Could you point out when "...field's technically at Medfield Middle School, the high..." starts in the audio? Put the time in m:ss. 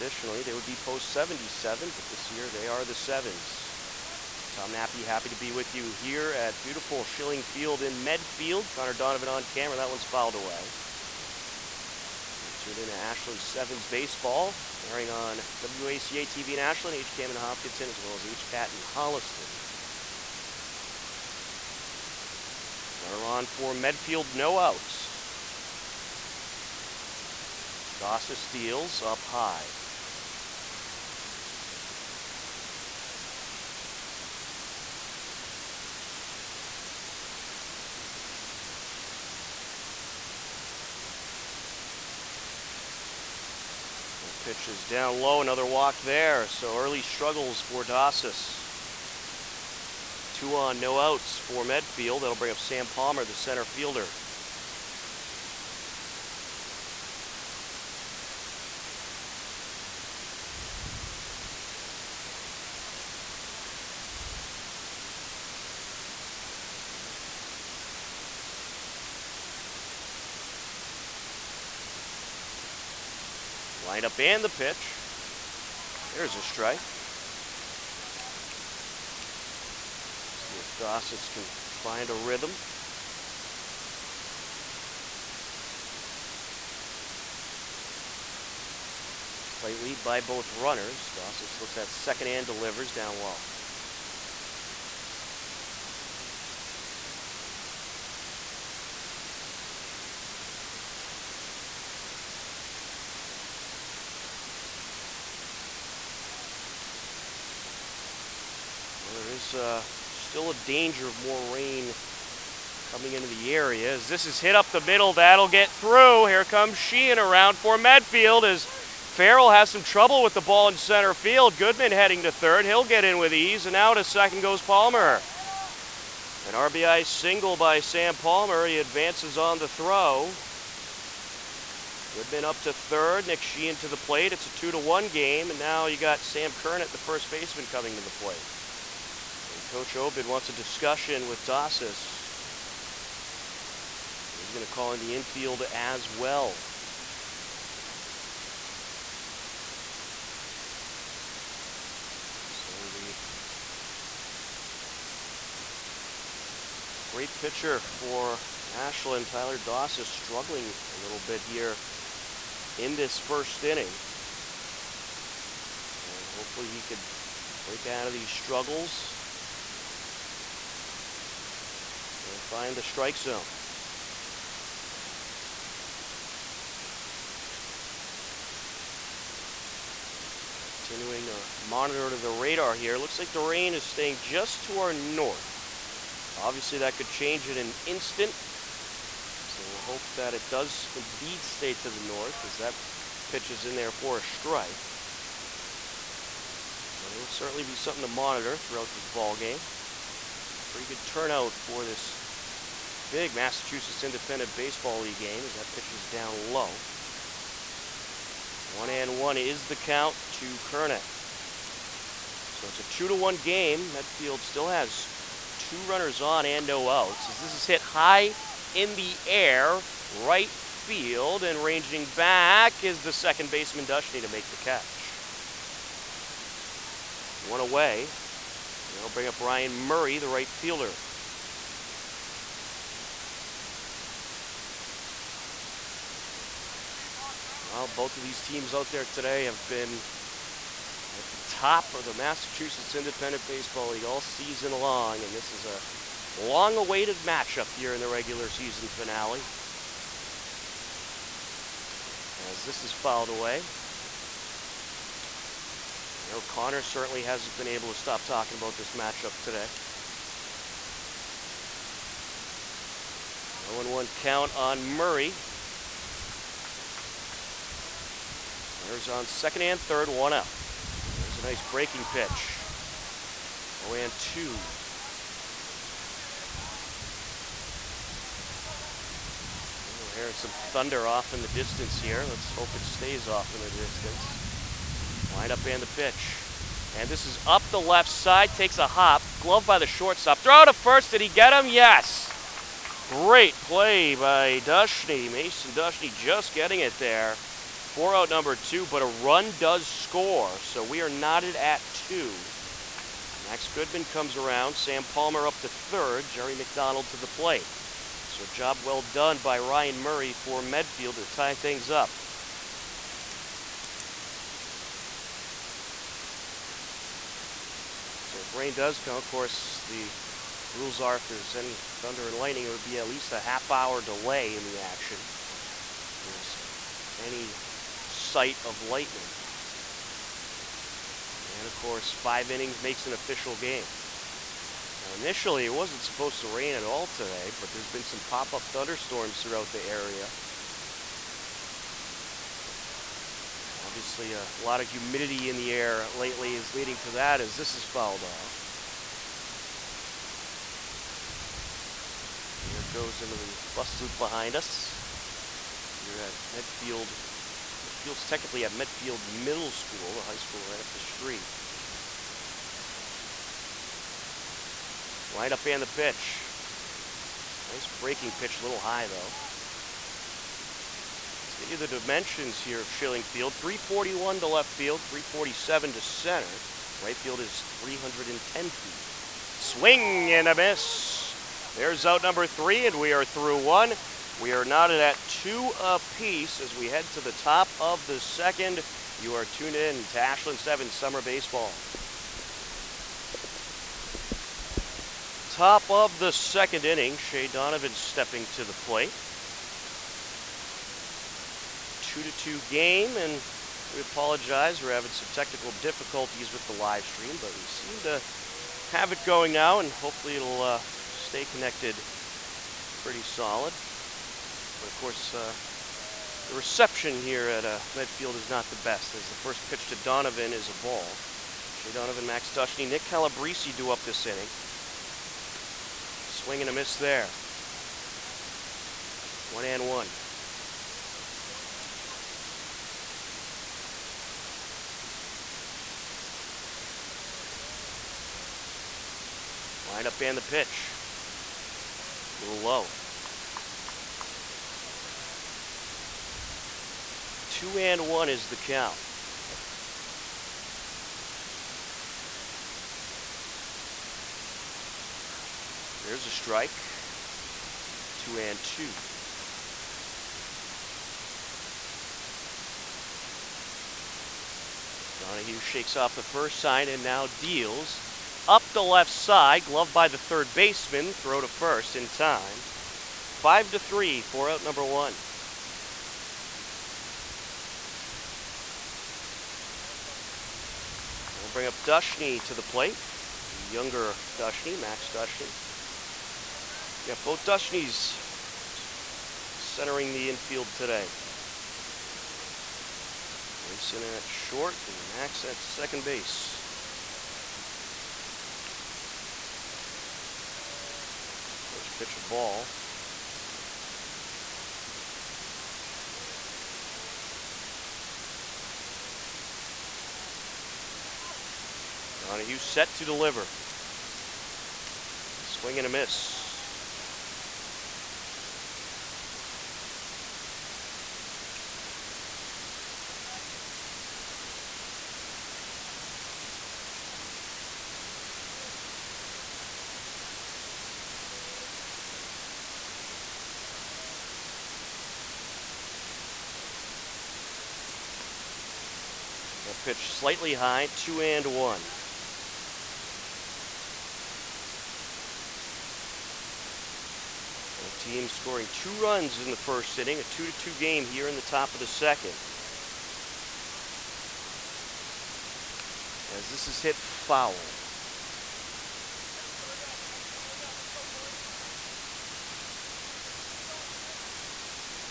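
5:57.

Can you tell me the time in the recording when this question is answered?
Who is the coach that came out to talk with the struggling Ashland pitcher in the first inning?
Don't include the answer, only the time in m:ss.
2:19.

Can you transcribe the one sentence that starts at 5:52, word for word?
And there it goes into the bus loop behind us.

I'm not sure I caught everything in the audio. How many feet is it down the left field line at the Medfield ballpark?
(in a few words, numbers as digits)
341.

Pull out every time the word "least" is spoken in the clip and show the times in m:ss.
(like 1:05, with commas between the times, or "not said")
5:23.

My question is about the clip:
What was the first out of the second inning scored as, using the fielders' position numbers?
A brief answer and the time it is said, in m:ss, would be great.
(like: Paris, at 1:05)
5-3, at 7:53.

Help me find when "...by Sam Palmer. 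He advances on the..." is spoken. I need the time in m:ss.
2:07.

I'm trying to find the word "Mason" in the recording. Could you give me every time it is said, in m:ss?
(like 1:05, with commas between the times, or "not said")
4:55, 8:13.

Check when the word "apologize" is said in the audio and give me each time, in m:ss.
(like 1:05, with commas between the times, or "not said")
6:43.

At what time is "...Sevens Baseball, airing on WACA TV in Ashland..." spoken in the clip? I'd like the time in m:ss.
0:13.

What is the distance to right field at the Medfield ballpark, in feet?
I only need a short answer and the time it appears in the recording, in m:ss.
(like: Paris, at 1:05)
310, at 6:17.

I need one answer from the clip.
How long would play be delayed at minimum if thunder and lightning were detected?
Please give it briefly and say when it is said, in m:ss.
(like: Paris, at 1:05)
half hour, at 5:23.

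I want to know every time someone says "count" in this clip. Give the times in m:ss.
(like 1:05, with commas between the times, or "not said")
3:29, 4:24, 7:28.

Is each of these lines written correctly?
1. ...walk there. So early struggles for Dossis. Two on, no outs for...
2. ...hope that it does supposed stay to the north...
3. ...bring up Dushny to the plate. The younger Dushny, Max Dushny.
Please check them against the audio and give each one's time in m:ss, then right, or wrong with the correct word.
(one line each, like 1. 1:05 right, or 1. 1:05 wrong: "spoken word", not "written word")
1. 0:45 right
2. 3:09 wrong: "indeed", not "supposed"
3. 8:01 right.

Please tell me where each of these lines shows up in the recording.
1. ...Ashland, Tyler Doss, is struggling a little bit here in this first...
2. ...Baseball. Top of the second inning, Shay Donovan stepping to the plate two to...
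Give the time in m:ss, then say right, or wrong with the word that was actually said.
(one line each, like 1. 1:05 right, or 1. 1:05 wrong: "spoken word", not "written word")
1. 2:38 right
2. 6:31 right.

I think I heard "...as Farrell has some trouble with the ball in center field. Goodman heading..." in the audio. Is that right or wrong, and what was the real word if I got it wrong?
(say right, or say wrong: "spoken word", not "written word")
right.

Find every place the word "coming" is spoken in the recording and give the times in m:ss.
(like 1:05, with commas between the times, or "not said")
1:52, 2:17.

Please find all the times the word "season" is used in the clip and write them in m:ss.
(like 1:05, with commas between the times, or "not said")
4:04, 4:08.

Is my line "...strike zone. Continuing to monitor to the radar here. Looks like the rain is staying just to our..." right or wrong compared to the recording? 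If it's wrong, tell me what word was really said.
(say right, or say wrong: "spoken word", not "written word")
right.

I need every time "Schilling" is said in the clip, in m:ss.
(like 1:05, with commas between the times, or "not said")
0:07, 6:12.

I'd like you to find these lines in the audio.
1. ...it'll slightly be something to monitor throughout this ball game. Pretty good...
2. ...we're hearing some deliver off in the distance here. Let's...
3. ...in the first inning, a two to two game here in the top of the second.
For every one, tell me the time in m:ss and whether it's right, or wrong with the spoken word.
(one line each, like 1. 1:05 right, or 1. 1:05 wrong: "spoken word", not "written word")
1. 3:17 wrong: "certainly", not "slightly"
2. 4:40 wrong: "thunder", not "deliver"
3. 9:09 right.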